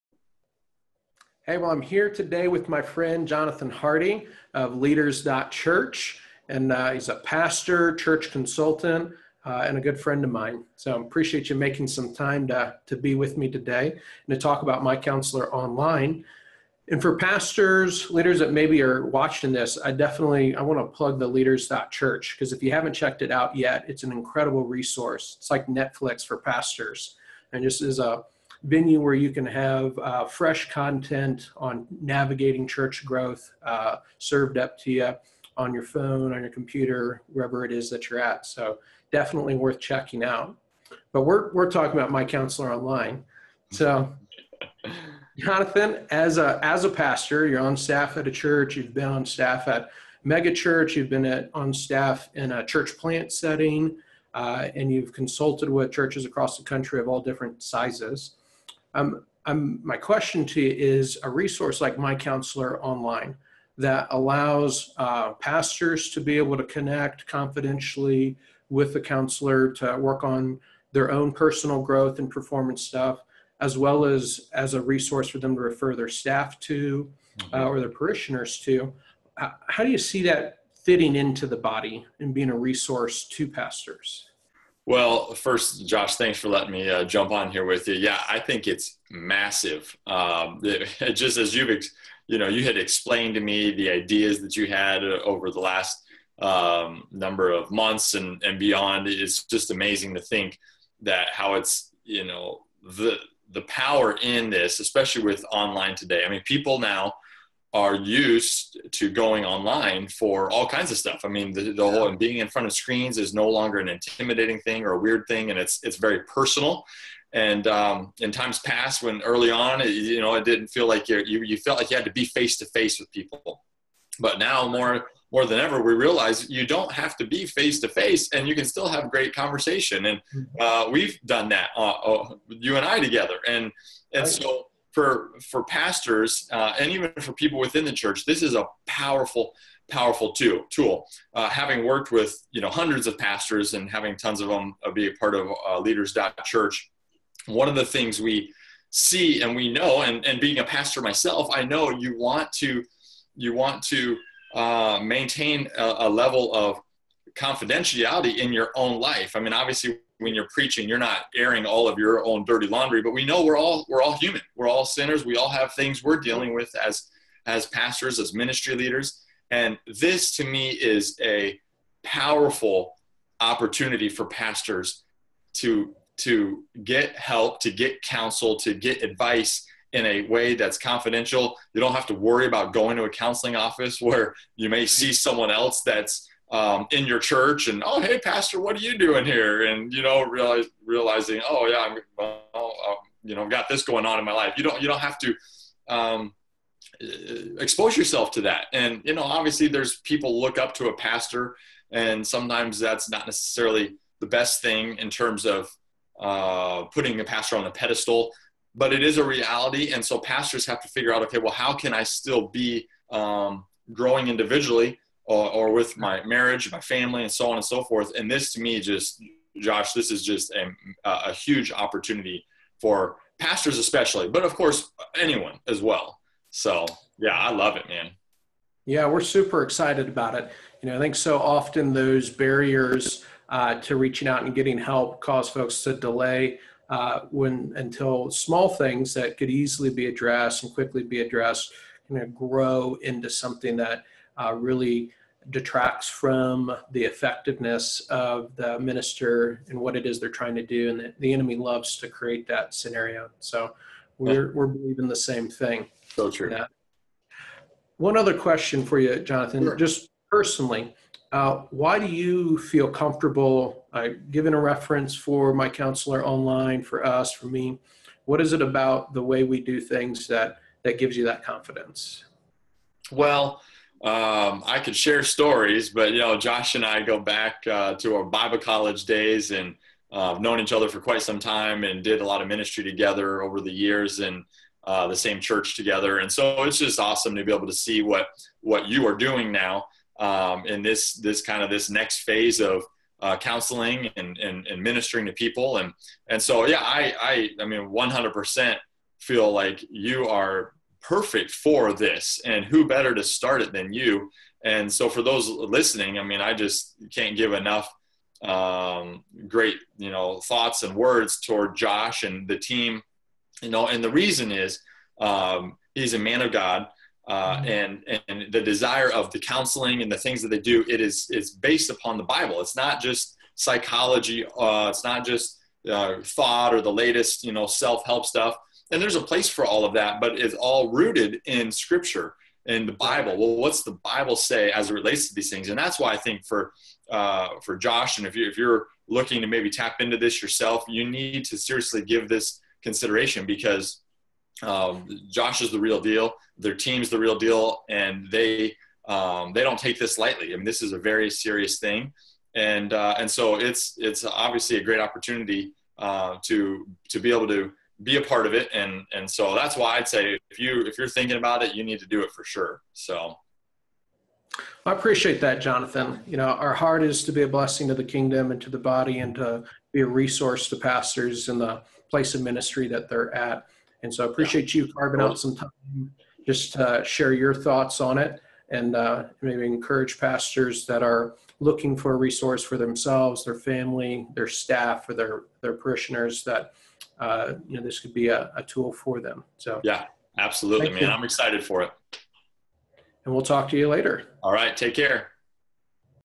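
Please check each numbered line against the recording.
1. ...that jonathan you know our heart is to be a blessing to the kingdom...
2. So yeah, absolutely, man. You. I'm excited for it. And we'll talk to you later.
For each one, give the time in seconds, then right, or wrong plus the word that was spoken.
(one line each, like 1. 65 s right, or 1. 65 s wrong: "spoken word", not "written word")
1. 365 s right
2. 389 s right.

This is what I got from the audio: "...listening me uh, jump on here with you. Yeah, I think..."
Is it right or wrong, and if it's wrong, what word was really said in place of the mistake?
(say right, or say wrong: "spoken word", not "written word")
wrong: "letting", not "listening".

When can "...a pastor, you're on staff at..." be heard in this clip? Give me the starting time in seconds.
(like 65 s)
46 s.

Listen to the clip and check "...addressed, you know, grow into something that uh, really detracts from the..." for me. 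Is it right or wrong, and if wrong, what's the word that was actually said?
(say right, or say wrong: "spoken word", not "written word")
right.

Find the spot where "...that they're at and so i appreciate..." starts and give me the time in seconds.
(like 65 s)
372 s.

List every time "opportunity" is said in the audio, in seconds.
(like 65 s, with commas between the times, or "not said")
173 s, 221 s, 354 s.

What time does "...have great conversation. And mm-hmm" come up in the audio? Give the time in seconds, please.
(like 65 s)
128 s.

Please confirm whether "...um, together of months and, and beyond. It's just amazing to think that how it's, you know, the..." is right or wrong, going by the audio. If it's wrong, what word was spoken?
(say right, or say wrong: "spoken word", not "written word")
wrong: "number", not "together".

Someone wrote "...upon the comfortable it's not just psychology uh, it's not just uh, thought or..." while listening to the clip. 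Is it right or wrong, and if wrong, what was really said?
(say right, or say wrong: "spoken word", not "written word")
wrong: "bible", not "comfortable".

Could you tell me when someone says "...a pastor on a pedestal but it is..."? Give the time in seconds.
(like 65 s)
207 s.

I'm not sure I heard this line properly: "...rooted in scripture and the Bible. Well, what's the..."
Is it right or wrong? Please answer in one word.
right.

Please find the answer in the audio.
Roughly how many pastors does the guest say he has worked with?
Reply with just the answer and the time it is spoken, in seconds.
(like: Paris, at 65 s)
hundreds, at 142 s.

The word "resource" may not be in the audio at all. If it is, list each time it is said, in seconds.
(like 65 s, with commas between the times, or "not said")
24 s, 61 s, 74 s, 82 s, 370 s, 382 s.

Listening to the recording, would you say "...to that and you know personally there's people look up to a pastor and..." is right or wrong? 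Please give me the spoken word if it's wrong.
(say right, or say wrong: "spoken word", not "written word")
wrong: "obviously", not "personally".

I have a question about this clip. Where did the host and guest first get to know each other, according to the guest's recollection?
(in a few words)
Bible college.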